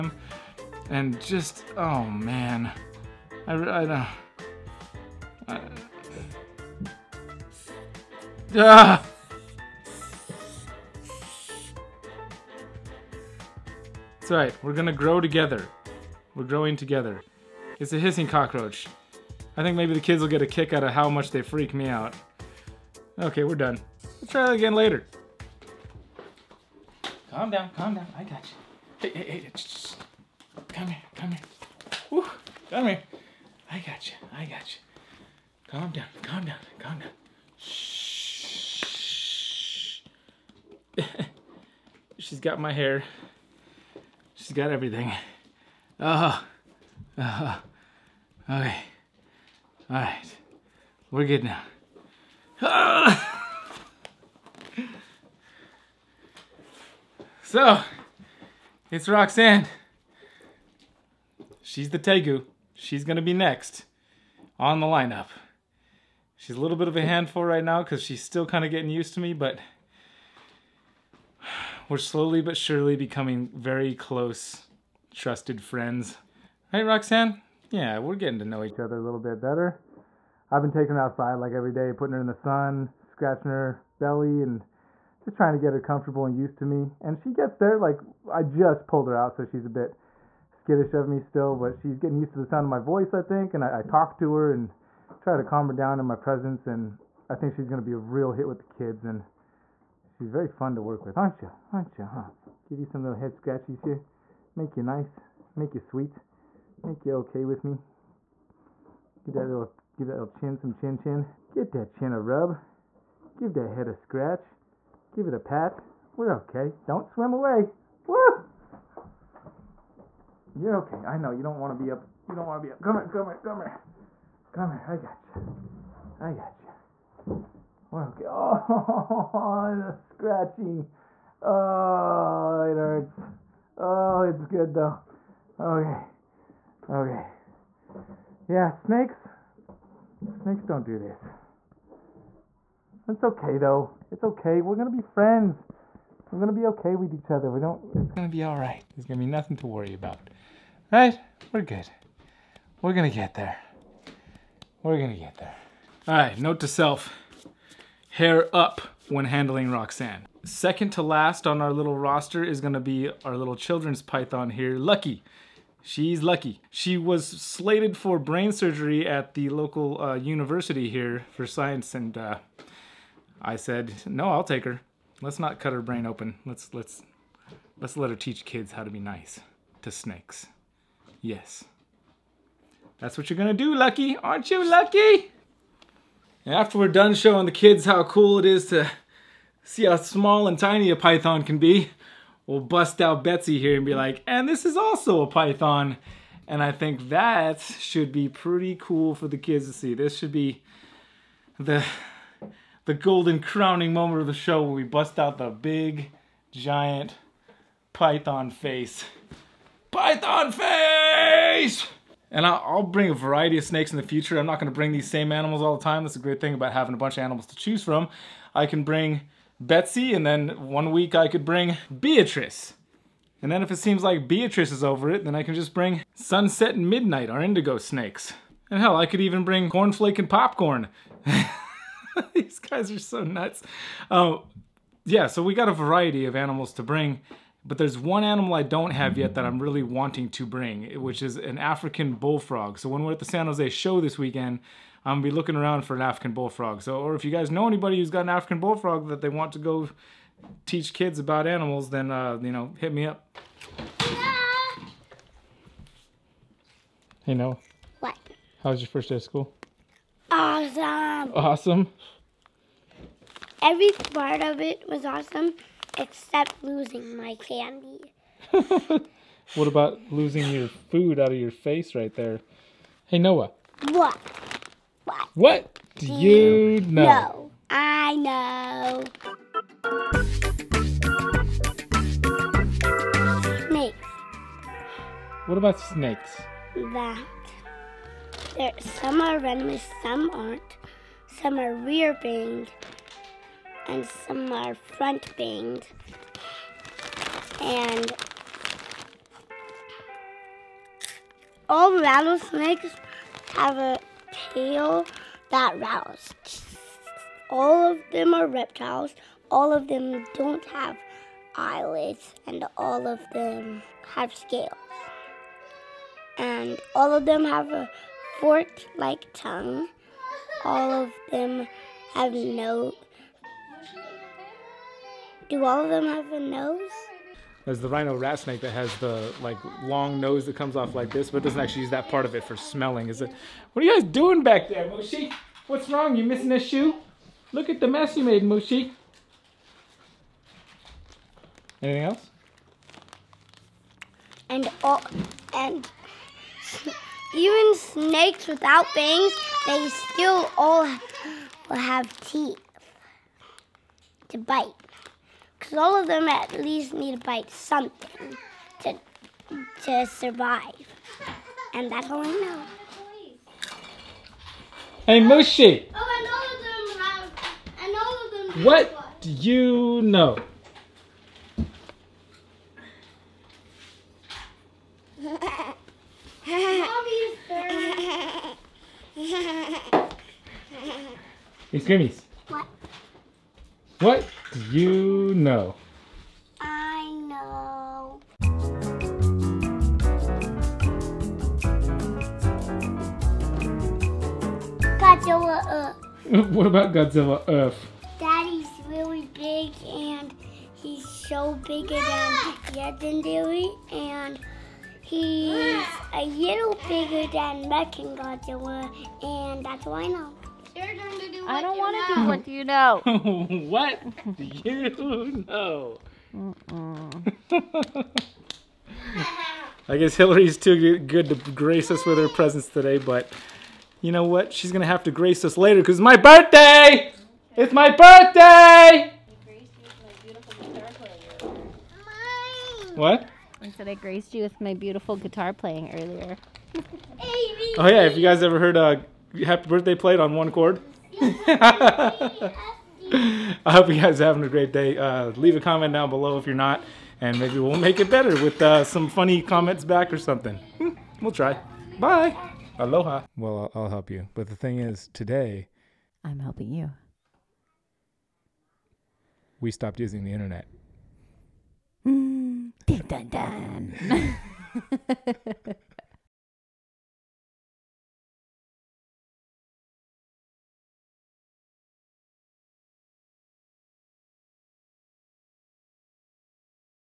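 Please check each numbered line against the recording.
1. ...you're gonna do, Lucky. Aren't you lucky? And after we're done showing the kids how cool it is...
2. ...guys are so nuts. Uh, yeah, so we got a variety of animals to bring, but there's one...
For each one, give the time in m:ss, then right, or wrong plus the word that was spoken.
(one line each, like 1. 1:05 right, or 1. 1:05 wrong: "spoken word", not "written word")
1. 3:03 right
2. 3:52 right.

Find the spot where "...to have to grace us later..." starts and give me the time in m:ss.
7:04.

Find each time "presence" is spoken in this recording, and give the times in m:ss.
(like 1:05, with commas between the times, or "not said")
1:36, 7:02.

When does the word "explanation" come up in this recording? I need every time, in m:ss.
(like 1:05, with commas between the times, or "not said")
not said.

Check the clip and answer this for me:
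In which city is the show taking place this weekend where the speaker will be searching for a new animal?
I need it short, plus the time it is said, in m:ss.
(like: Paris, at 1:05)
San Jose, at 4:03.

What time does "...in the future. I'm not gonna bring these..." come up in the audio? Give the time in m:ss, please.
3:33.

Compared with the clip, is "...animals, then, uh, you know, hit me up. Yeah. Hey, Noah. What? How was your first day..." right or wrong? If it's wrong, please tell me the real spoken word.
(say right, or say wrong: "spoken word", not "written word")
right.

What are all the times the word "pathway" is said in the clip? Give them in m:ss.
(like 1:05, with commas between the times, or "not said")
not said.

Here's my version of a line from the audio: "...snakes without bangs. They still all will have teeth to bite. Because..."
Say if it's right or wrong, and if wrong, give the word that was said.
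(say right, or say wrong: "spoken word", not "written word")
right.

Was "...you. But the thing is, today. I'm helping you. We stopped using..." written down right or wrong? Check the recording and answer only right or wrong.
right.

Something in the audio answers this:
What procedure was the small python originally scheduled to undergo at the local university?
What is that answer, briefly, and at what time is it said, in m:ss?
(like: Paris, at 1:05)
Brain surgery, at 2:48.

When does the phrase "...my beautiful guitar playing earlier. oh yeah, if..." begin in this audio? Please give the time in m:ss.
7:14.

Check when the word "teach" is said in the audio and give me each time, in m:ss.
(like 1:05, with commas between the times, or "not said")
2:58, 4:10.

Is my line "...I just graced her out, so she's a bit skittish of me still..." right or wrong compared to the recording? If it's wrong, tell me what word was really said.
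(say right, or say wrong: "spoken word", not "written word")
wrong: "pulled", not "graced".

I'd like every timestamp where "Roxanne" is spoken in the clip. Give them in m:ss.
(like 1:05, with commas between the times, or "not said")
0:59, 1:16, 2:39.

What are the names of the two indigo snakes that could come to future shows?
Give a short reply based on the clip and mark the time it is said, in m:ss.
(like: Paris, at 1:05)
Sunset and Midnight, at 3:46.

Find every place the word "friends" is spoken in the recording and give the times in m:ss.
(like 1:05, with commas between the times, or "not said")
1:15, 2:25.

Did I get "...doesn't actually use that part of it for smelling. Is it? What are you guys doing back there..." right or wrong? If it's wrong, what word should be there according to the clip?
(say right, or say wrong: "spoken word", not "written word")
right.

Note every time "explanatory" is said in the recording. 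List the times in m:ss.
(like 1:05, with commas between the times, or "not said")
not said.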